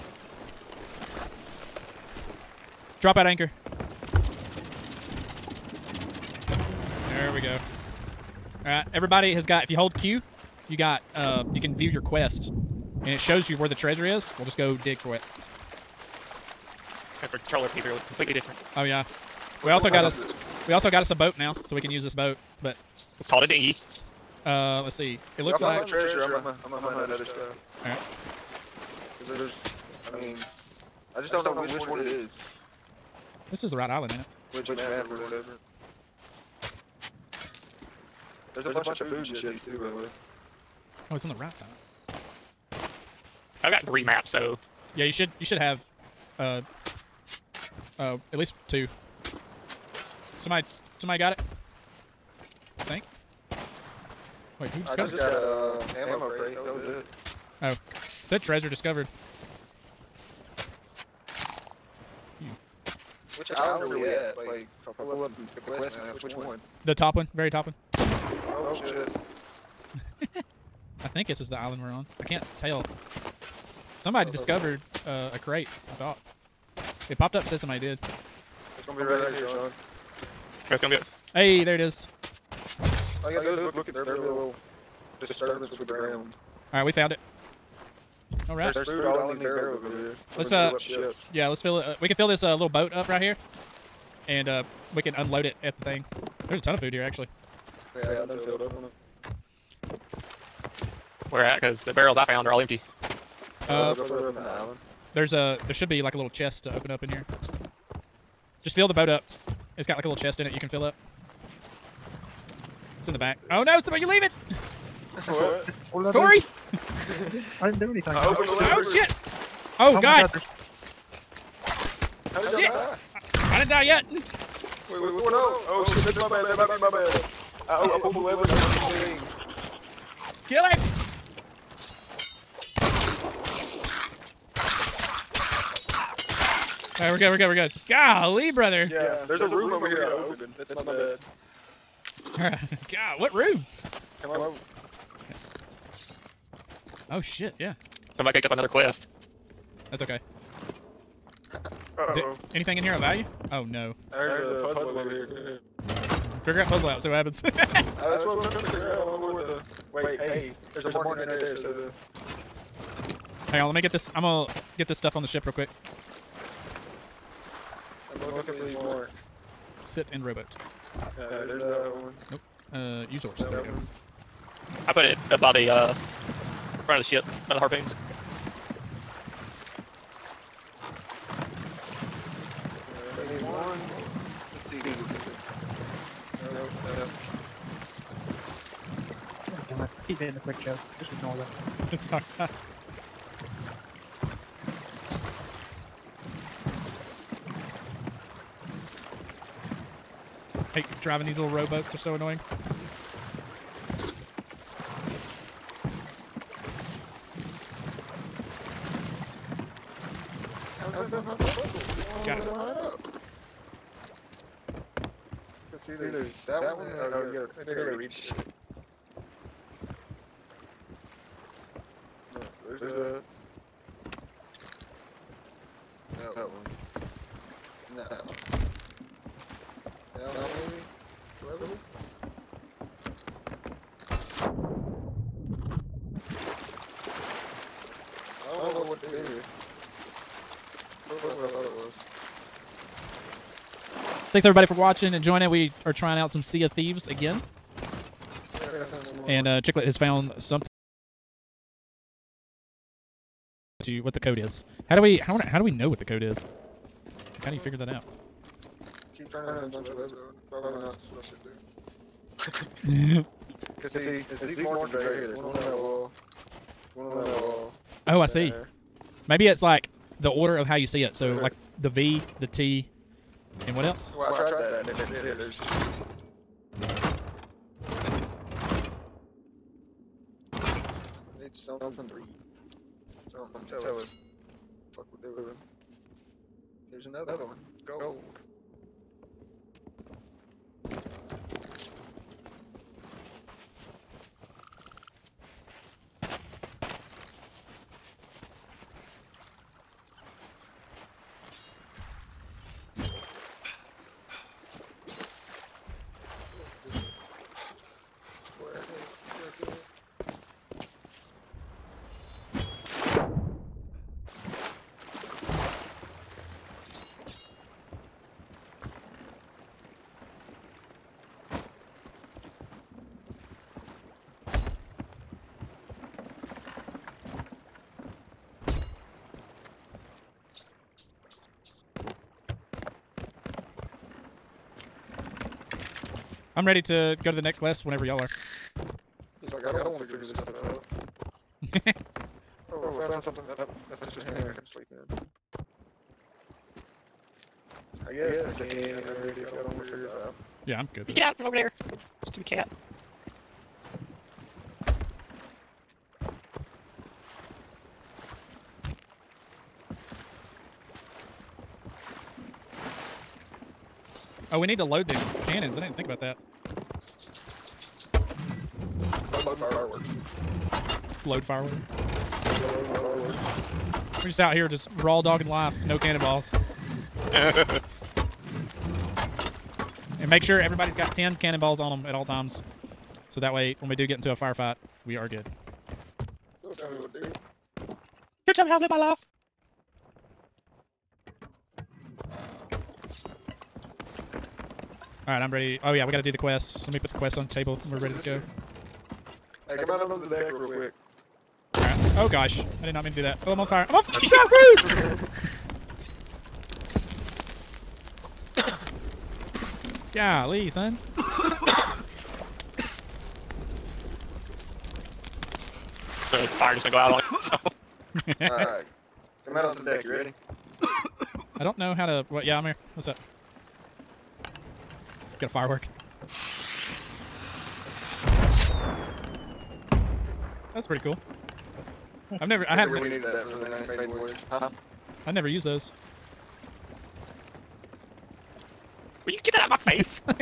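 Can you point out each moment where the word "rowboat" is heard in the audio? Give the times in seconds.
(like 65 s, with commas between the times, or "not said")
170 s, 201 s.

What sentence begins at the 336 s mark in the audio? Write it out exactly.
I'm ready to go to the next class whenever y'all are.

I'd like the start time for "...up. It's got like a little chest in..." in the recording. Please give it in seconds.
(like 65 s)
109 s.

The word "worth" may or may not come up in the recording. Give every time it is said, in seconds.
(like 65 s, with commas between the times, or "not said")
not said.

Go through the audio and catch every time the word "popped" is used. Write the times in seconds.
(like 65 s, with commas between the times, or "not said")
77 s.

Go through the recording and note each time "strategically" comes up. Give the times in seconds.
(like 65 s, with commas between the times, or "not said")
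not said.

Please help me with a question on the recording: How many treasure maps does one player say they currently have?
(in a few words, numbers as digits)
3.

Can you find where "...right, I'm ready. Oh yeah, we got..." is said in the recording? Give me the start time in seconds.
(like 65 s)
395 s.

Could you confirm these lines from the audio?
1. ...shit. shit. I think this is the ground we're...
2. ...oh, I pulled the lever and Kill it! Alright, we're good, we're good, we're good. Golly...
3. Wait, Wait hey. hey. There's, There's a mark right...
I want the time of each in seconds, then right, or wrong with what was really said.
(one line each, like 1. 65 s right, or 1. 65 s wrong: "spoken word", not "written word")
1. 68 s wrong: "island", not "ground"
2. 127 s right
3. 159 s right.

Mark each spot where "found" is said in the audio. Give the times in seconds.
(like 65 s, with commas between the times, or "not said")
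86 s, 102 s, 249 s, 343 s.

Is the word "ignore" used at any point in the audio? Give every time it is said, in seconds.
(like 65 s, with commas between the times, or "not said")
191 s.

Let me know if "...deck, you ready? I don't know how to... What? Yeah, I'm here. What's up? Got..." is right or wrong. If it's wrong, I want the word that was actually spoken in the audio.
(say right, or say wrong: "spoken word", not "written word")
right.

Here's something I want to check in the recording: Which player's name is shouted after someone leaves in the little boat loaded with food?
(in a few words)
Corey.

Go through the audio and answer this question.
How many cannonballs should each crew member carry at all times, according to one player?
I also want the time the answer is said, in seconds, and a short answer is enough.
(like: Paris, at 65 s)
10, at 381 s.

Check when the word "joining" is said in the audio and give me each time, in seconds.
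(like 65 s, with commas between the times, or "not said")
245 s.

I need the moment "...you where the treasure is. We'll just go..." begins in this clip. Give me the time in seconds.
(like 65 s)
13 s.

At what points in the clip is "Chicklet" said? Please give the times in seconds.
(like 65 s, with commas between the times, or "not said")
249 s.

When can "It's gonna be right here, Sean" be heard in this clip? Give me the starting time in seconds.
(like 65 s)
78 s.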